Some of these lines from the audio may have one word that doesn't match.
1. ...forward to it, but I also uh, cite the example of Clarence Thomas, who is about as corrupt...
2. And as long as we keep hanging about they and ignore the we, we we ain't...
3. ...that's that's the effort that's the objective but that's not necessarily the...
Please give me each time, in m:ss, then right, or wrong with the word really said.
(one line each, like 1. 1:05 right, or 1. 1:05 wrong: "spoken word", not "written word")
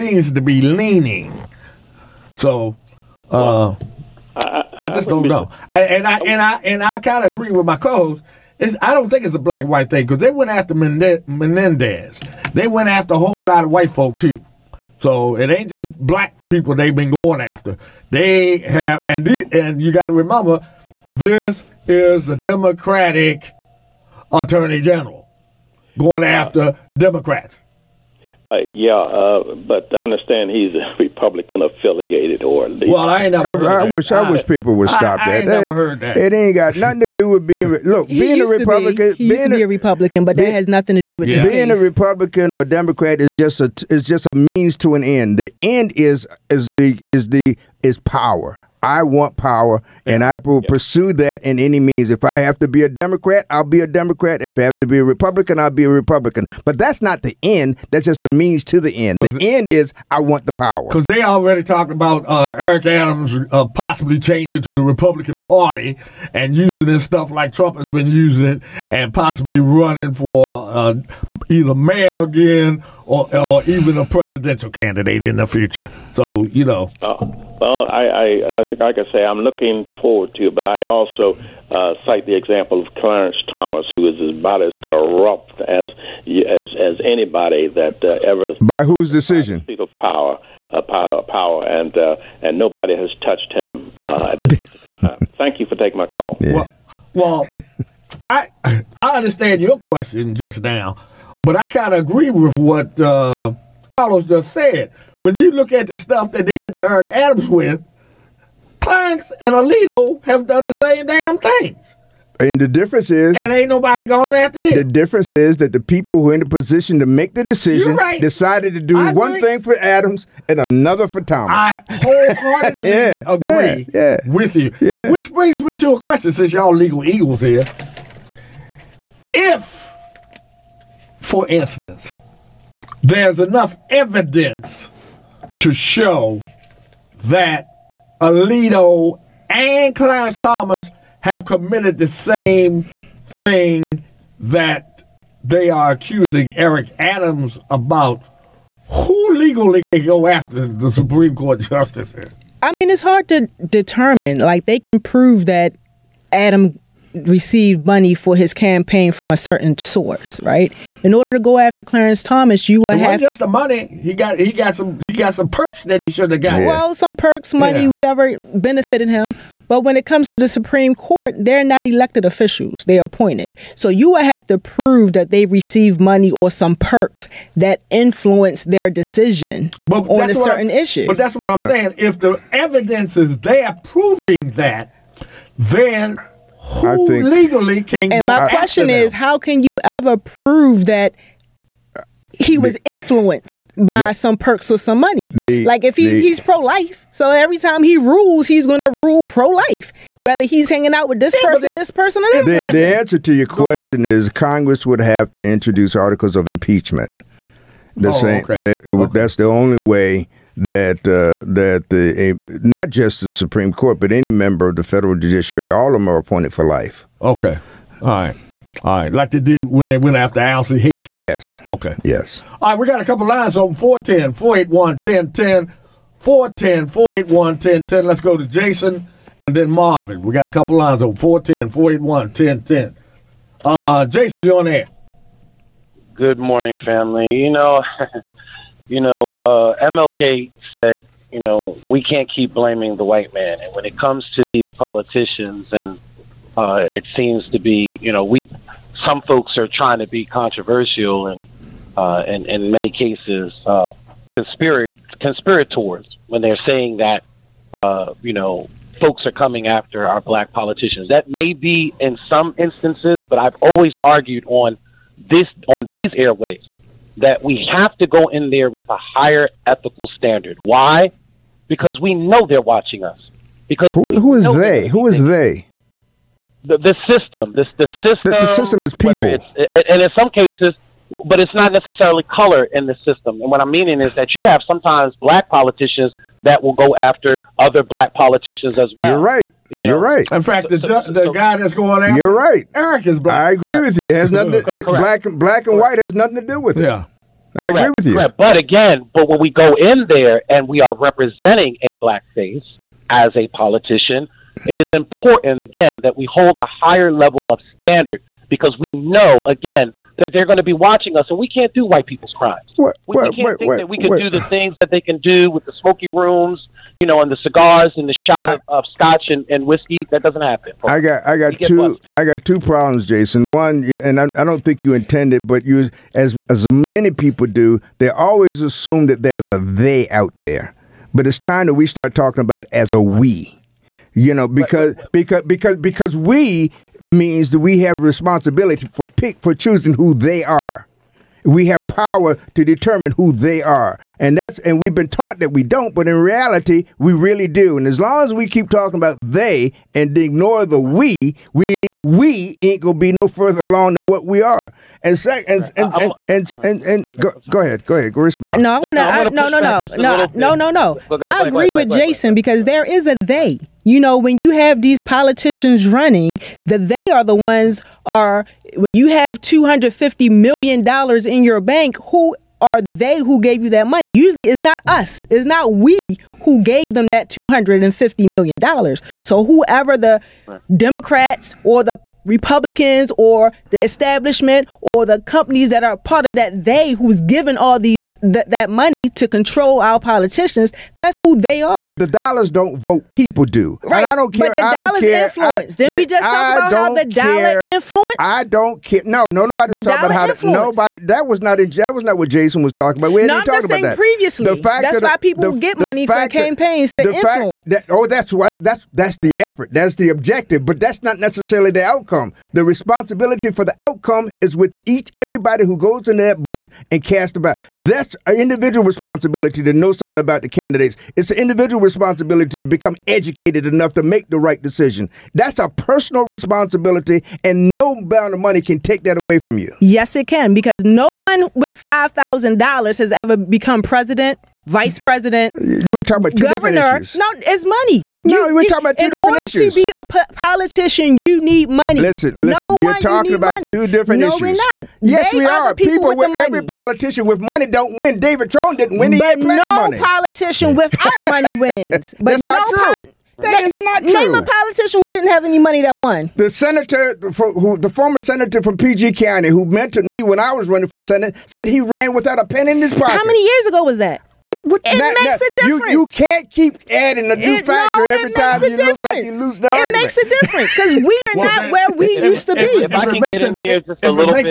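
1. 1:20 right
2. 5:47 wrong: "talking", not "hanging"
3. 6:48 right.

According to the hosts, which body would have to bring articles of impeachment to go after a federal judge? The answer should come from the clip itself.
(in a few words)
Congress.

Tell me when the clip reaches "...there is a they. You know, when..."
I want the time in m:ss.
6:02.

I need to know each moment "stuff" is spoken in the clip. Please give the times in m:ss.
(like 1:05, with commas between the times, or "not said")
1:07, 1:45.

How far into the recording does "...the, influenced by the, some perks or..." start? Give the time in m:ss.
3:12.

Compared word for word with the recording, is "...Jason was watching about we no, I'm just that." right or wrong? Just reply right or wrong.
wrong.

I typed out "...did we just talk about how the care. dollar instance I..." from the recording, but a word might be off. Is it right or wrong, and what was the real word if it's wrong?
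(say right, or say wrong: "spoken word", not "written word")
wrong: "influence", not "instance".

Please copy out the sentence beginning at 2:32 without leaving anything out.
I mean, it's hard to determine.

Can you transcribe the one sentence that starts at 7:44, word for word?
What, what, it not, makes not, a difference.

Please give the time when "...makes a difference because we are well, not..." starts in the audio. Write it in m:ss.
7:49.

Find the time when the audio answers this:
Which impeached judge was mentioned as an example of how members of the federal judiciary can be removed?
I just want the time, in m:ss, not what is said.
3:40.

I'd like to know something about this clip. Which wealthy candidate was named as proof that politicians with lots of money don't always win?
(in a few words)
David Trone.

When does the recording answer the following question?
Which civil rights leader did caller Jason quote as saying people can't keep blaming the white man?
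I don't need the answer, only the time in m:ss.
3:59.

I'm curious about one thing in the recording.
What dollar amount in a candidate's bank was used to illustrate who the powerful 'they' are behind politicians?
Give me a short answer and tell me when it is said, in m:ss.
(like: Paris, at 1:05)
$250 million, at 6:09.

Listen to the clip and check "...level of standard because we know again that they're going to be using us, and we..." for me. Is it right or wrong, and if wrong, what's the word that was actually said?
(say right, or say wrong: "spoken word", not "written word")
wrong: "watching", not "using".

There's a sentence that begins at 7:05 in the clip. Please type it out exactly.
That's a personal responsibility, and no amount of money can take that away from you.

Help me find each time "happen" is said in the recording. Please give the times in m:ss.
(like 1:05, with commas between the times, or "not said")
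5:20.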